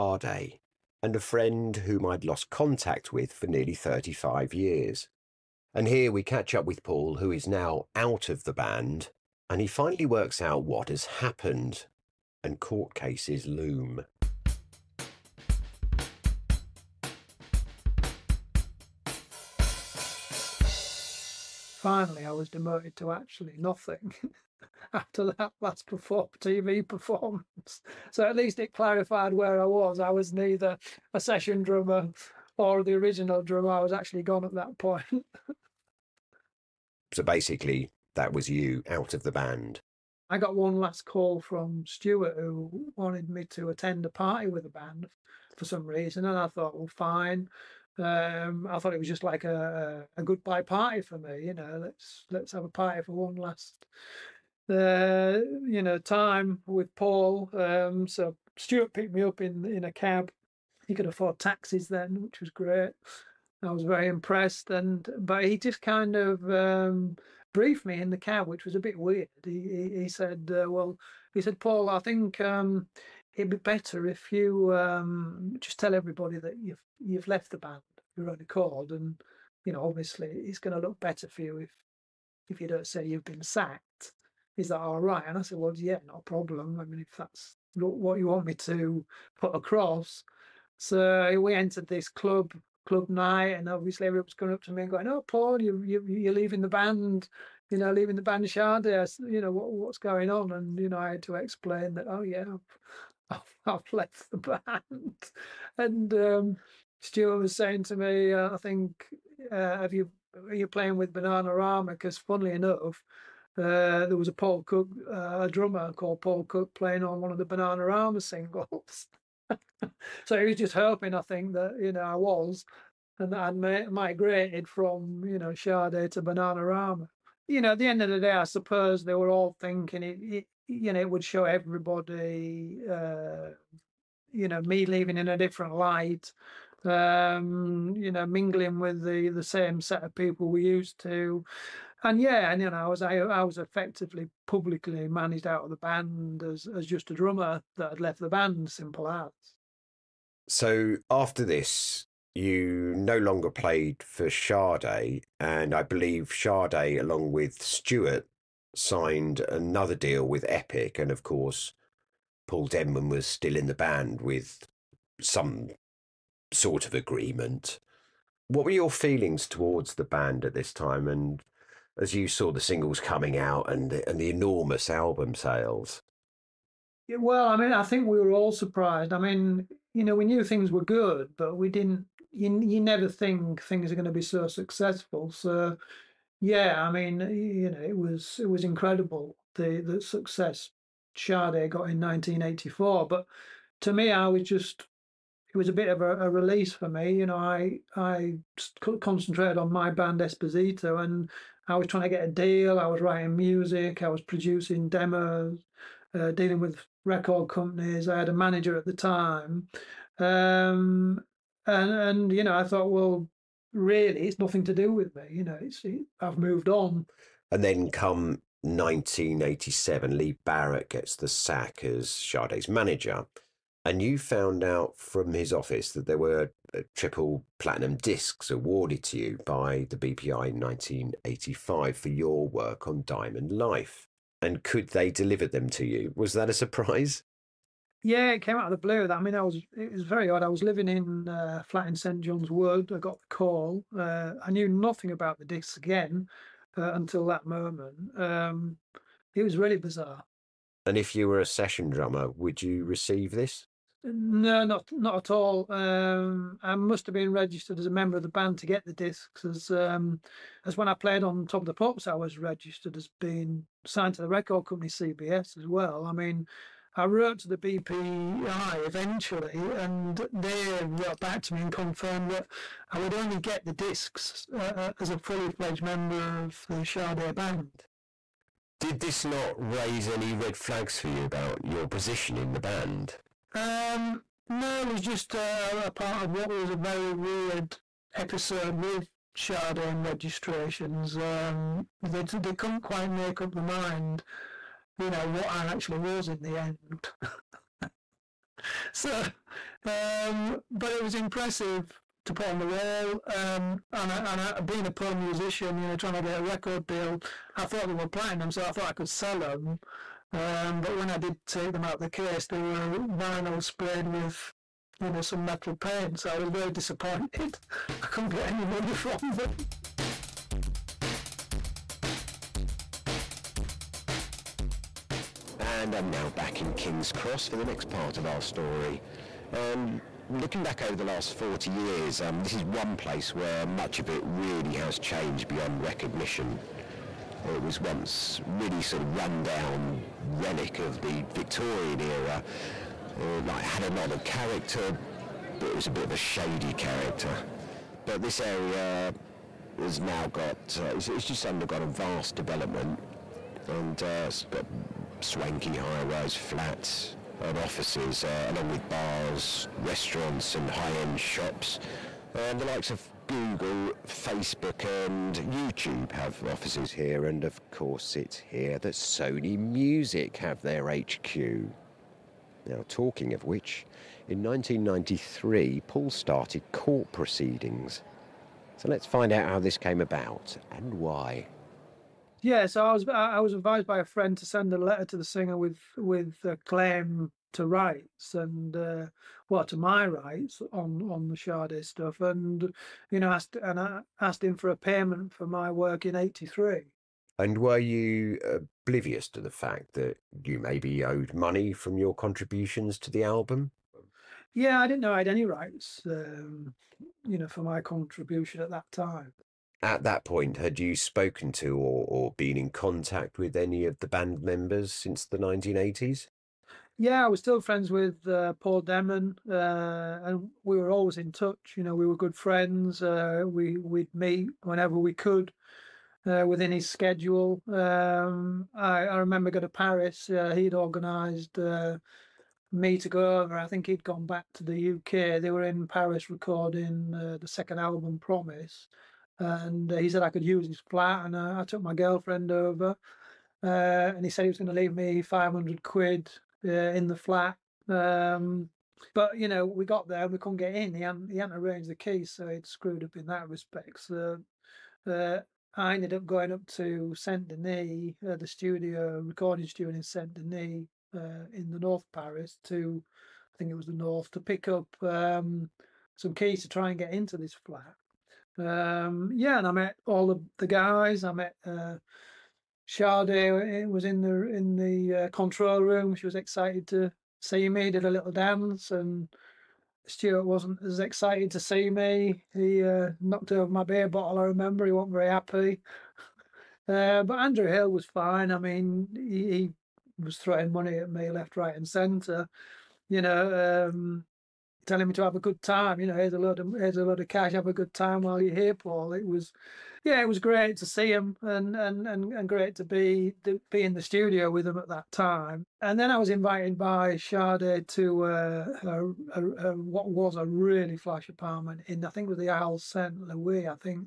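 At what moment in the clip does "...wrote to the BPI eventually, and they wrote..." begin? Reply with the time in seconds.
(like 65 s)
267 s.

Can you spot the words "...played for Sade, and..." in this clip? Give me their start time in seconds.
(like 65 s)
153 s.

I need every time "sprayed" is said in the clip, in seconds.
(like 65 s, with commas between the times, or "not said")
313 s.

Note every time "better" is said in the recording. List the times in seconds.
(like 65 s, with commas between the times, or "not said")
73 s, 81 s.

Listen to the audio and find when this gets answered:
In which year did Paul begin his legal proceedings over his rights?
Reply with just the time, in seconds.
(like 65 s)
374 s.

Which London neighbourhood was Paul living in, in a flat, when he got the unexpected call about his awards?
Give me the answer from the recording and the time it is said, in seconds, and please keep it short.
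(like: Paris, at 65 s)
St John's Wood, at 241 s.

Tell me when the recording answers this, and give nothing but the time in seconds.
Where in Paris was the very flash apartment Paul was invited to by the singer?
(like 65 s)
512 s.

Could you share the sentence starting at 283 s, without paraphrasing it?
Um, no, it was just a, a part of what was a very weird episode with Sade and registrations.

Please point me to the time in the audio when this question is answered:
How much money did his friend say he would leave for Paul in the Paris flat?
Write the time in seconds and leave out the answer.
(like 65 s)
445 s.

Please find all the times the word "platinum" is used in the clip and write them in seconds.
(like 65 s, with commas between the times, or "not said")
227 s, 308 s.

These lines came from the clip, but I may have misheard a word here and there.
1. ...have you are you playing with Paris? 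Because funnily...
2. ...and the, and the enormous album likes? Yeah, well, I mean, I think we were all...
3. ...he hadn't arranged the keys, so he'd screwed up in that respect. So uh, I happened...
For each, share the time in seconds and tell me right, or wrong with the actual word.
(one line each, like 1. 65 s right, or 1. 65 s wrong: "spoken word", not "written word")
1. 109 s wrong: "Bananarama", not "Paris"
2. 173 s wrong: "sales", not "likes"
3. 451 s wrong: "ended", not "happened".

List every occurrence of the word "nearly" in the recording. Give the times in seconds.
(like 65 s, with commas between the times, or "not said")
3 s.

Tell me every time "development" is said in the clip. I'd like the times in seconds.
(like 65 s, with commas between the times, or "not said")
352 s.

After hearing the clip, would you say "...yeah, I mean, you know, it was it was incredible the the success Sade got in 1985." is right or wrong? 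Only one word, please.
wrong.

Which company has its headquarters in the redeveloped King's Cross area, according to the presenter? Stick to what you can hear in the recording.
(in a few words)
Sony Music.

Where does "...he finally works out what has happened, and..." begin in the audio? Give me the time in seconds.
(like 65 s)
9 s.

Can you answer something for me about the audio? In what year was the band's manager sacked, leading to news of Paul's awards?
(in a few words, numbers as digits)
1987.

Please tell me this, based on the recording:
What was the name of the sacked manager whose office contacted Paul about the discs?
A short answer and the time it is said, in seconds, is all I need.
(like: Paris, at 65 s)
Lee Barrett, at 220 s.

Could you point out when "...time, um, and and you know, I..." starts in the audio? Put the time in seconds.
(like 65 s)
208 s.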